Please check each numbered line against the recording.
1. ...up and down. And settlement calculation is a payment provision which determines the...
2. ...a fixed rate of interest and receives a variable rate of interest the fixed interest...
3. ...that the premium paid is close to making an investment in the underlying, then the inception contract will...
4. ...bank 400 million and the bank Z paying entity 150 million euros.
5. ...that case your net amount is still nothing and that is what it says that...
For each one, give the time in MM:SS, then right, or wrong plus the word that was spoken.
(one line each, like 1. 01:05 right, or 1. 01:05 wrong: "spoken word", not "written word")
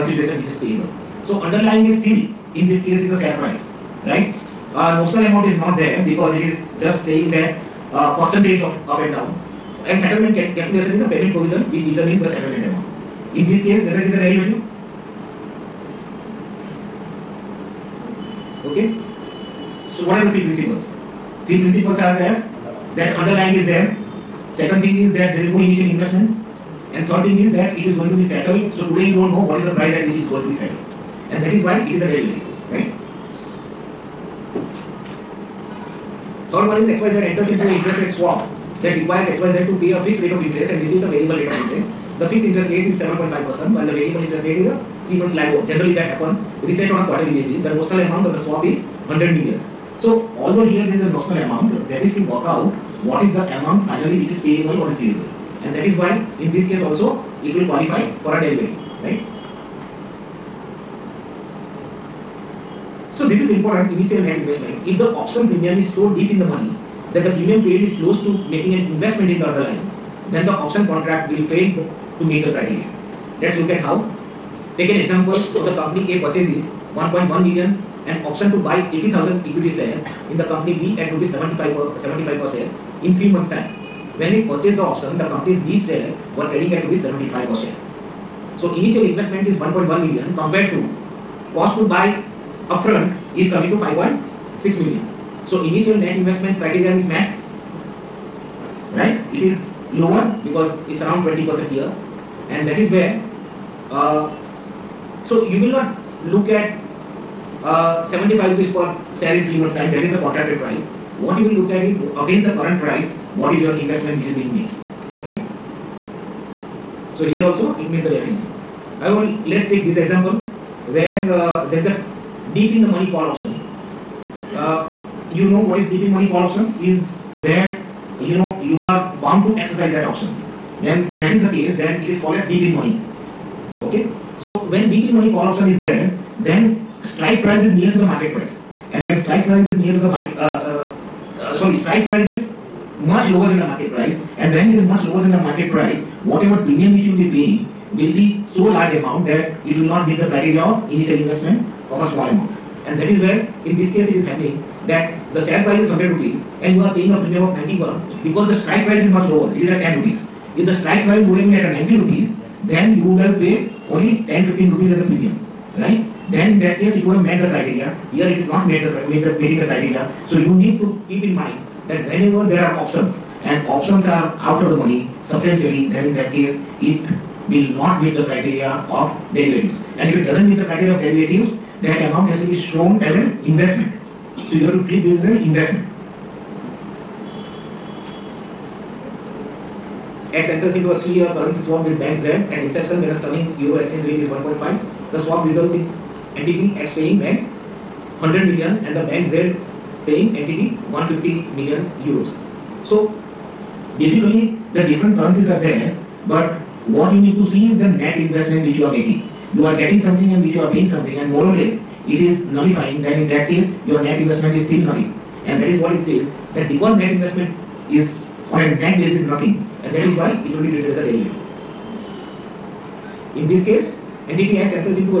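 1. 00:08 right
2. 00:39 right
3. 01:07 wrong: "option", not "inception"
4. 03:17 wrong: "100", not "400"
5. 03:33 wrong: "investment", not "amount".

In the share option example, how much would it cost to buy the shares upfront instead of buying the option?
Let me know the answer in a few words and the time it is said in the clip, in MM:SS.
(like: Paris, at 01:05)
5.6 million, at 01:33.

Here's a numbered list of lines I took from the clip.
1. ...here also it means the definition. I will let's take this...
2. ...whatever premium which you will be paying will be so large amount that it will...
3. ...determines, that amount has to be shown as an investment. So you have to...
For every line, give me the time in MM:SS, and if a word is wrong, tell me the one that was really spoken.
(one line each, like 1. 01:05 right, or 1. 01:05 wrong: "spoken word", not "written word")
1. 01:57 right
2. 02:26 right
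3. 03:01 wrong: "derivatives", not "determines".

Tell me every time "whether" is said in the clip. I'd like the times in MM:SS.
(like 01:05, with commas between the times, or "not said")
00:13.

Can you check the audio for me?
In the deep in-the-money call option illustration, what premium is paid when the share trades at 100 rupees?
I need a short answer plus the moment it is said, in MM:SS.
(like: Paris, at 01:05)
91, at 02:37.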